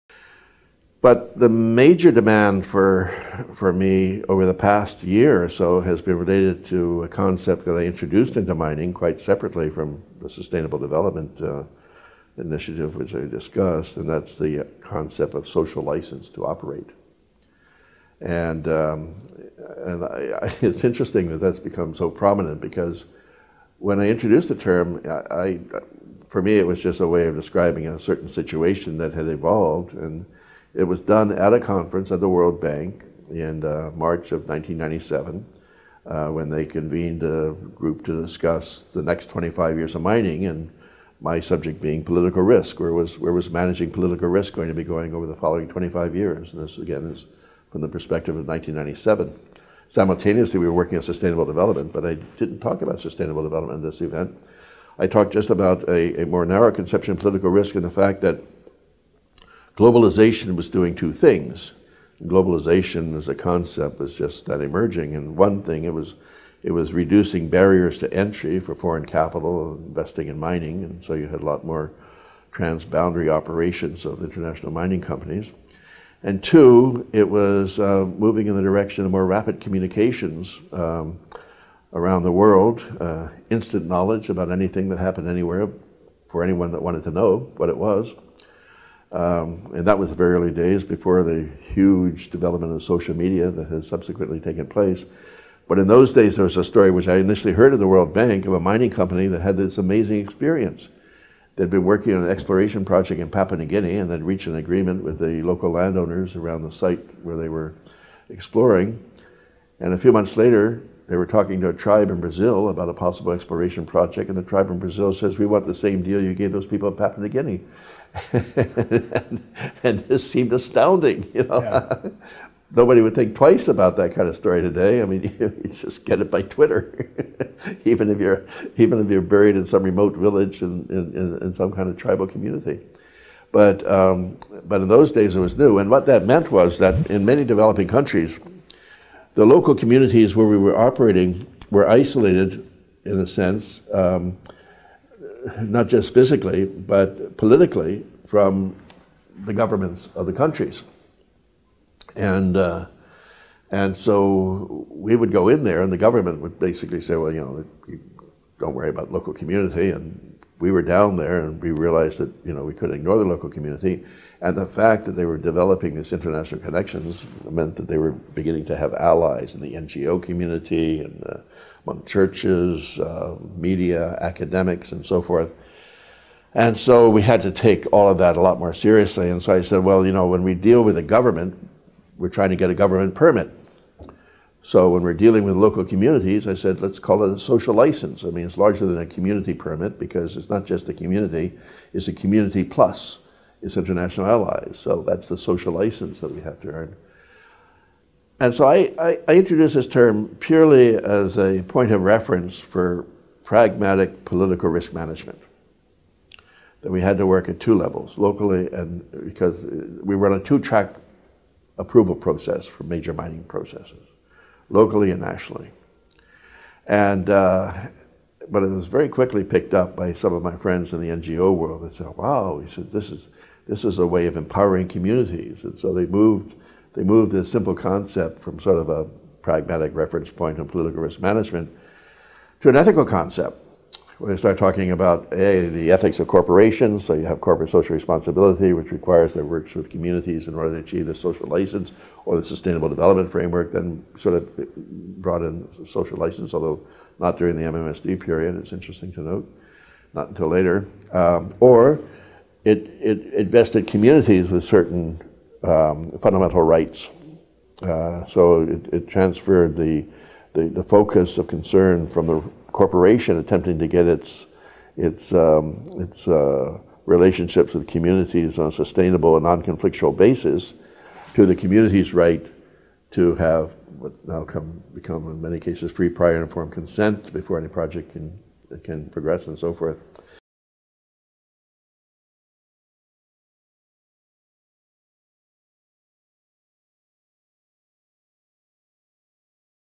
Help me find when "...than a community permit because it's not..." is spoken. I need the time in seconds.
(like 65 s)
188 s.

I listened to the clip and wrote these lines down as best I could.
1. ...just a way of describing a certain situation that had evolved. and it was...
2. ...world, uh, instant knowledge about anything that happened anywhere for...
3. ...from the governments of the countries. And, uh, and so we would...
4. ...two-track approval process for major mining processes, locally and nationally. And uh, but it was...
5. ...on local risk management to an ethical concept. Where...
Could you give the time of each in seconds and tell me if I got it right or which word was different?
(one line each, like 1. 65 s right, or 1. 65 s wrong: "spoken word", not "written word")
1. 26 s right
2. 82 s right
3. 148 s right
4. 210 s right
5. 230 s wrong: "political", not "local".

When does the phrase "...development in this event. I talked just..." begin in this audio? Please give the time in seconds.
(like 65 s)
53 s.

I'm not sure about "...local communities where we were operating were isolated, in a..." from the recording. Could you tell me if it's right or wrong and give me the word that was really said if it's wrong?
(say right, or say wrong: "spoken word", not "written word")
right.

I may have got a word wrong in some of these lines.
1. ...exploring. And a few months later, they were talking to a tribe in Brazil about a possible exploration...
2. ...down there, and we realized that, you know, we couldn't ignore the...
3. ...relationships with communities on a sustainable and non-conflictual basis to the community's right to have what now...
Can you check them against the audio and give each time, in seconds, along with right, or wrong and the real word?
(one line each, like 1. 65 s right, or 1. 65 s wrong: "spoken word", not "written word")
1. 108 s right
2. 160 s right
3. 267 s right.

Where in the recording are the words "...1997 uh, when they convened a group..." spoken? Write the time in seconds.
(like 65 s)
34 s.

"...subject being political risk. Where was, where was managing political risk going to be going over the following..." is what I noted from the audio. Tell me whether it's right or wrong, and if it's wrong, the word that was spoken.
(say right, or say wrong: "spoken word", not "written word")
right.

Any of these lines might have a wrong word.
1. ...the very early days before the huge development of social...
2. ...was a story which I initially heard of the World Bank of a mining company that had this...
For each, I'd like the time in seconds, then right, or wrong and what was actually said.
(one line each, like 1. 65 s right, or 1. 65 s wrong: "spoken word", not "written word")
1. 90 s right
2. 96 s right.